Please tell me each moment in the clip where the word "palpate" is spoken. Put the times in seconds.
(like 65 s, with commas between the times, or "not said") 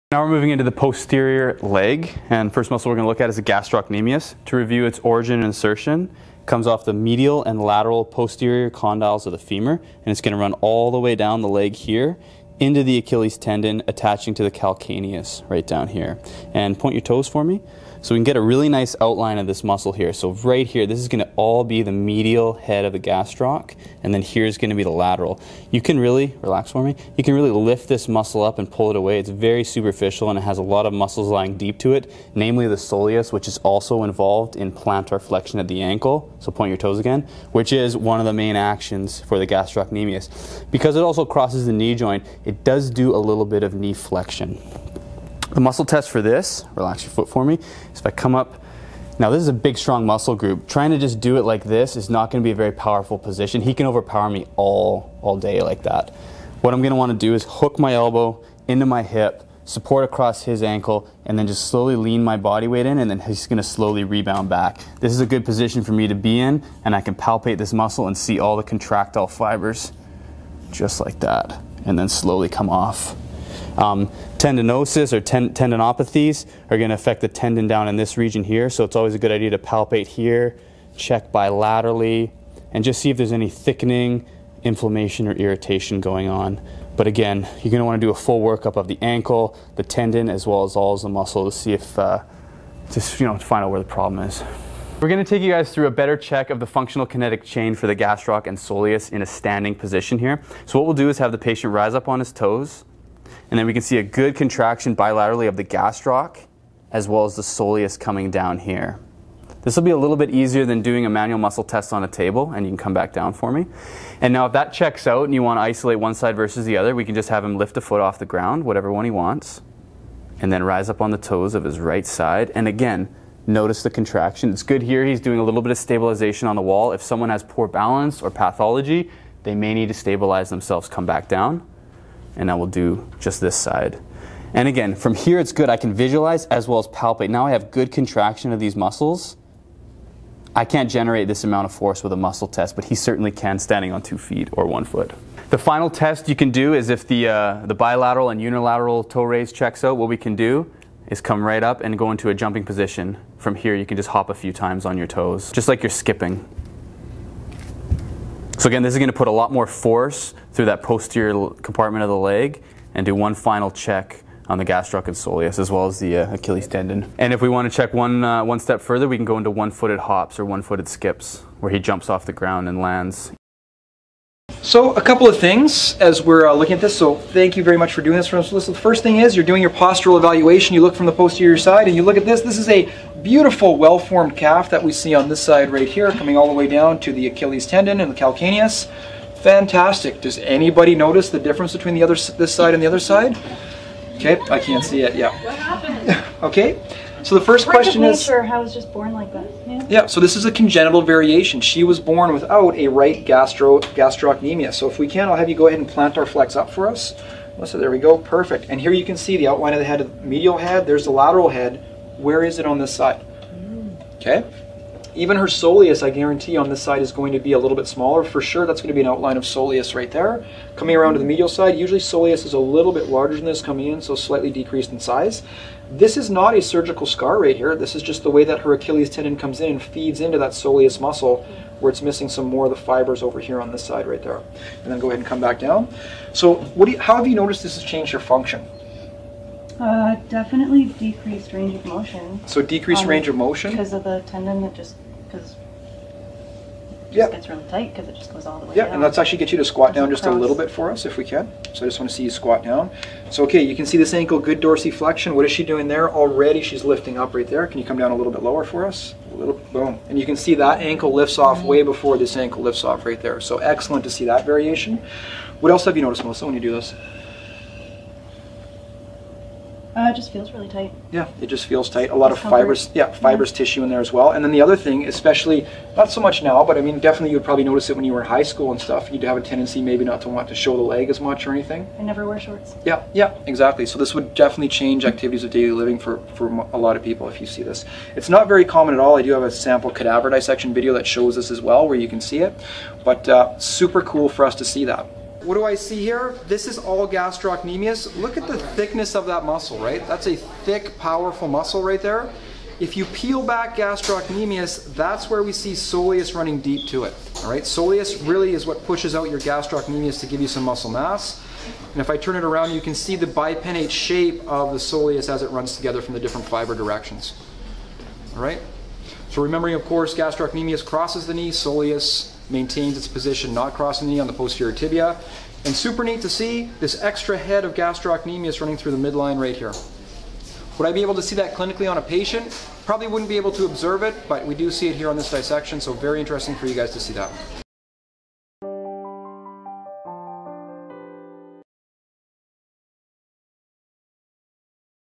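67 s, 79 s, 136 s.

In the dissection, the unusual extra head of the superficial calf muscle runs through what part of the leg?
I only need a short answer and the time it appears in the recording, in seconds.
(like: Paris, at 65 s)
midline, at 329 s.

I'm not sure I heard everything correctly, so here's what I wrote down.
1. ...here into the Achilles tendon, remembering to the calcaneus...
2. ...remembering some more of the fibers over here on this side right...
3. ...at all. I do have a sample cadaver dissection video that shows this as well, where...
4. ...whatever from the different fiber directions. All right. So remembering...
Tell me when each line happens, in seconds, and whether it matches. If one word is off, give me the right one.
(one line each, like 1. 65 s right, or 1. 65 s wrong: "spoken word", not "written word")
1. 11 s wrong: "attaching", not "remembering"
2. 232 s wrong: "missing", not "remembering"
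3. 288 s right
4. 315 s wrong: "together", not "whatever".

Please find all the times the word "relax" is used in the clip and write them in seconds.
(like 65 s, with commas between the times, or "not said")
26 s, 46 s.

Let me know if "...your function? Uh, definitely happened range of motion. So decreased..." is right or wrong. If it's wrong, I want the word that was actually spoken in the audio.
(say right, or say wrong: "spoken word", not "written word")
wrong: "decreased", not "happened".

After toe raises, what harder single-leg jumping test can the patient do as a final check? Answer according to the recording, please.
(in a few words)
one-footed hops.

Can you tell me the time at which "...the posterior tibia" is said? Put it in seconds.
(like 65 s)
324 s.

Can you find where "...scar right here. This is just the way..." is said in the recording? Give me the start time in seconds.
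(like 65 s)
227 s.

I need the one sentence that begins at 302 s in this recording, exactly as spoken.
If you peel back gastrocnemius, that's where we see soleus running deep to it.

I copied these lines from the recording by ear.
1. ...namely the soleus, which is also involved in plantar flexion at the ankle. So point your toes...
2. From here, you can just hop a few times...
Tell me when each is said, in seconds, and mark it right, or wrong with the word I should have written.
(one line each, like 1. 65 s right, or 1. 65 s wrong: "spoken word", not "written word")
1. 32 s right
2. 153 s right.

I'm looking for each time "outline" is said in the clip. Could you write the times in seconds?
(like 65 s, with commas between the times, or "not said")
18 s, 209 s, 219 s.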